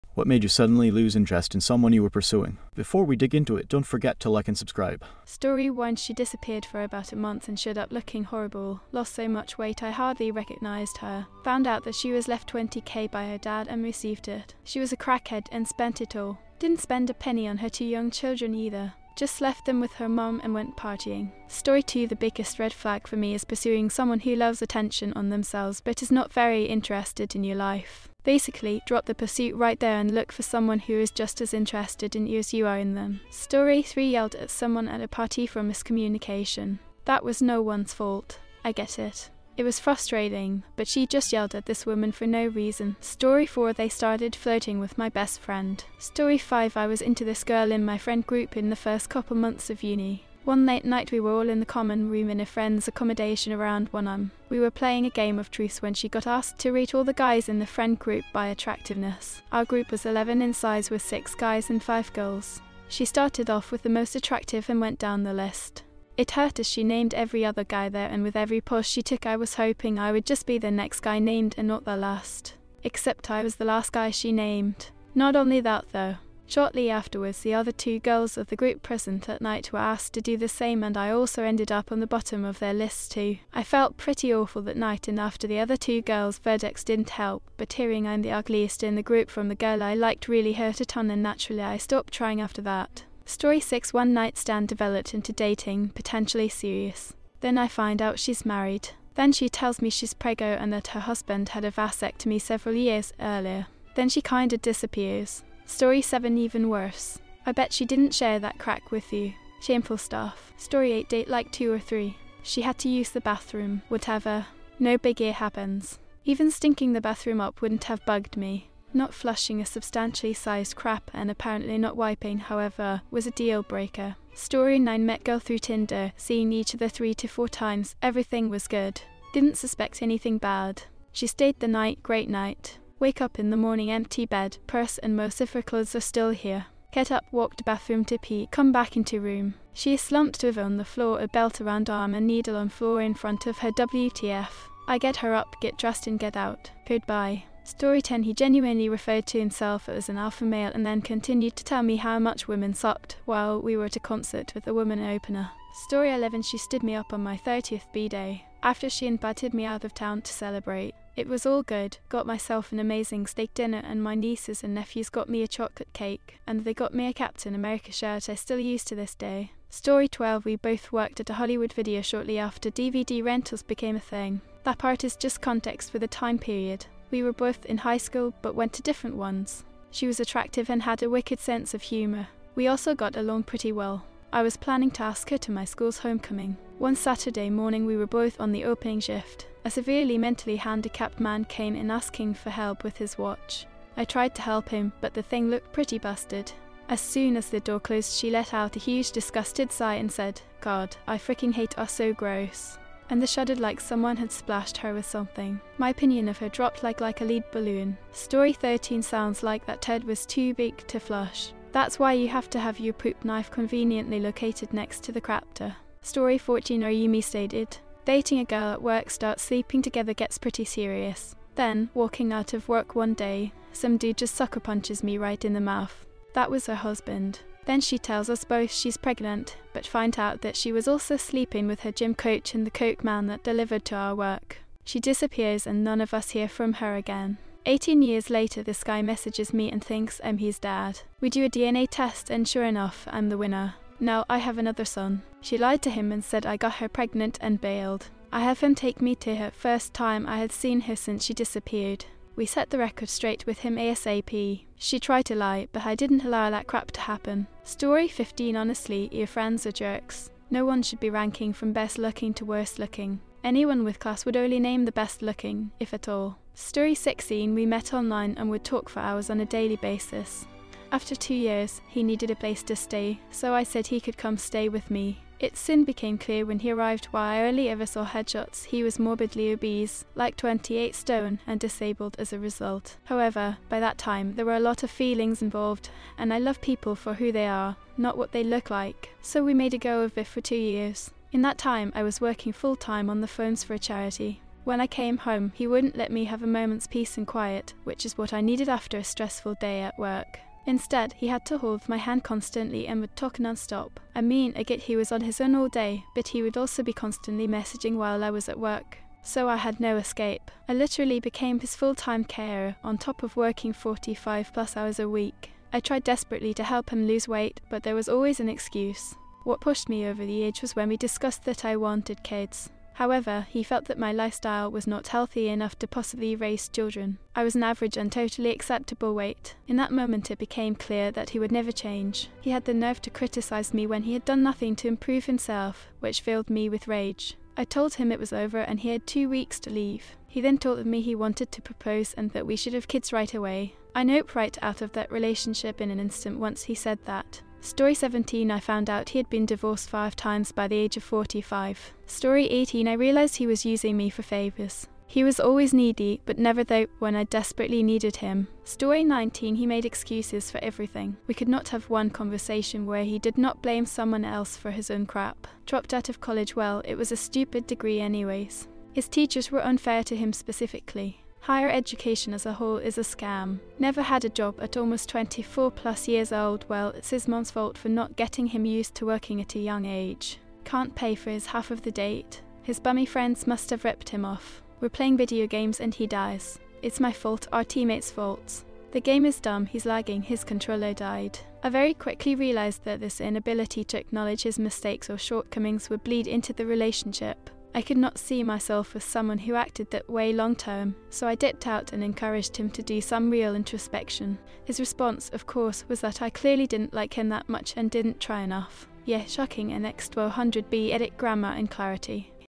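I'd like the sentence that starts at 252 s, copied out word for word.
We set the record straight with him ASAP.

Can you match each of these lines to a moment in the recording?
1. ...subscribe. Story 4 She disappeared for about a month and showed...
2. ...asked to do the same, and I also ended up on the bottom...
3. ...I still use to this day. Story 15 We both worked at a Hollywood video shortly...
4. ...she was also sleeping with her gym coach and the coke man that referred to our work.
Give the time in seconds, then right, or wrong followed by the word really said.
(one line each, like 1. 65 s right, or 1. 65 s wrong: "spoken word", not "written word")
1. 4 s wrong: "1", not "4"
2. 79 s right
3. 168 s wrong: "12", not "15"
4. 230 s wrong: "delivered", not "referred".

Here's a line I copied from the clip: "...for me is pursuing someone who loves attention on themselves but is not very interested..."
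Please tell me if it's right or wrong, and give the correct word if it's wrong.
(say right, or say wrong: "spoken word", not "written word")
right.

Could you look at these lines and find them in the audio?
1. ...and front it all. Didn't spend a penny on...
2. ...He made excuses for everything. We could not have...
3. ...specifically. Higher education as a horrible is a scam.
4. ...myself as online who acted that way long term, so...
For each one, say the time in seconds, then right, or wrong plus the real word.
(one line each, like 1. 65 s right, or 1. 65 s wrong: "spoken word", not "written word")
1. 15 s wrong: "spent", not "front"
2. 359 s right
3. 370 s wrong: "whole", not "horrible"
4. 398 s wrong: "someone", not "online".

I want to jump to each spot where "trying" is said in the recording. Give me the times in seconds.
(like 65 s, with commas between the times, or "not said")
92 s.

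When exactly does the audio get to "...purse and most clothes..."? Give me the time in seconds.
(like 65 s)
134 s.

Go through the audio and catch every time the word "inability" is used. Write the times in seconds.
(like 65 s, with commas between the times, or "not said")
393 s.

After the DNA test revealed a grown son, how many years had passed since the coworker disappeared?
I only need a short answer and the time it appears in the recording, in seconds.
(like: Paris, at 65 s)
18, at 237 s.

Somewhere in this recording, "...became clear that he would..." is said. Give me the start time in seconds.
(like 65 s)
330 s.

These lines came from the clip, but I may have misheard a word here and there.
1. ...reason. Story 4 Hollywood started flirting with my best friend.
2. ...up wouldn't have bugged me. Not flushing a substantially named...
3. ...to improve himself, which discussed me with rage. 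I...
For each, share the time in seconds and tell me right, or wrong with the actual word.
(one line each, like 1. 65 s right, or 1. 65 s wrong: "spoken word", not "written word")
1. 42 s wrong: "They", not "Hollywood"
2. 117 s wrong: "sized", not "named"
3. 334 s wrong: "filled", not "discussed".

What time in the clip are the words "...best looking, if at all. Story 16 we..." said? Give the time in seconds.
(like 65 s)
264 s.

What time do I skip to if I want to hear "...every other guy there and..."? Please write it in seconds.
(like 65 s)
67 s.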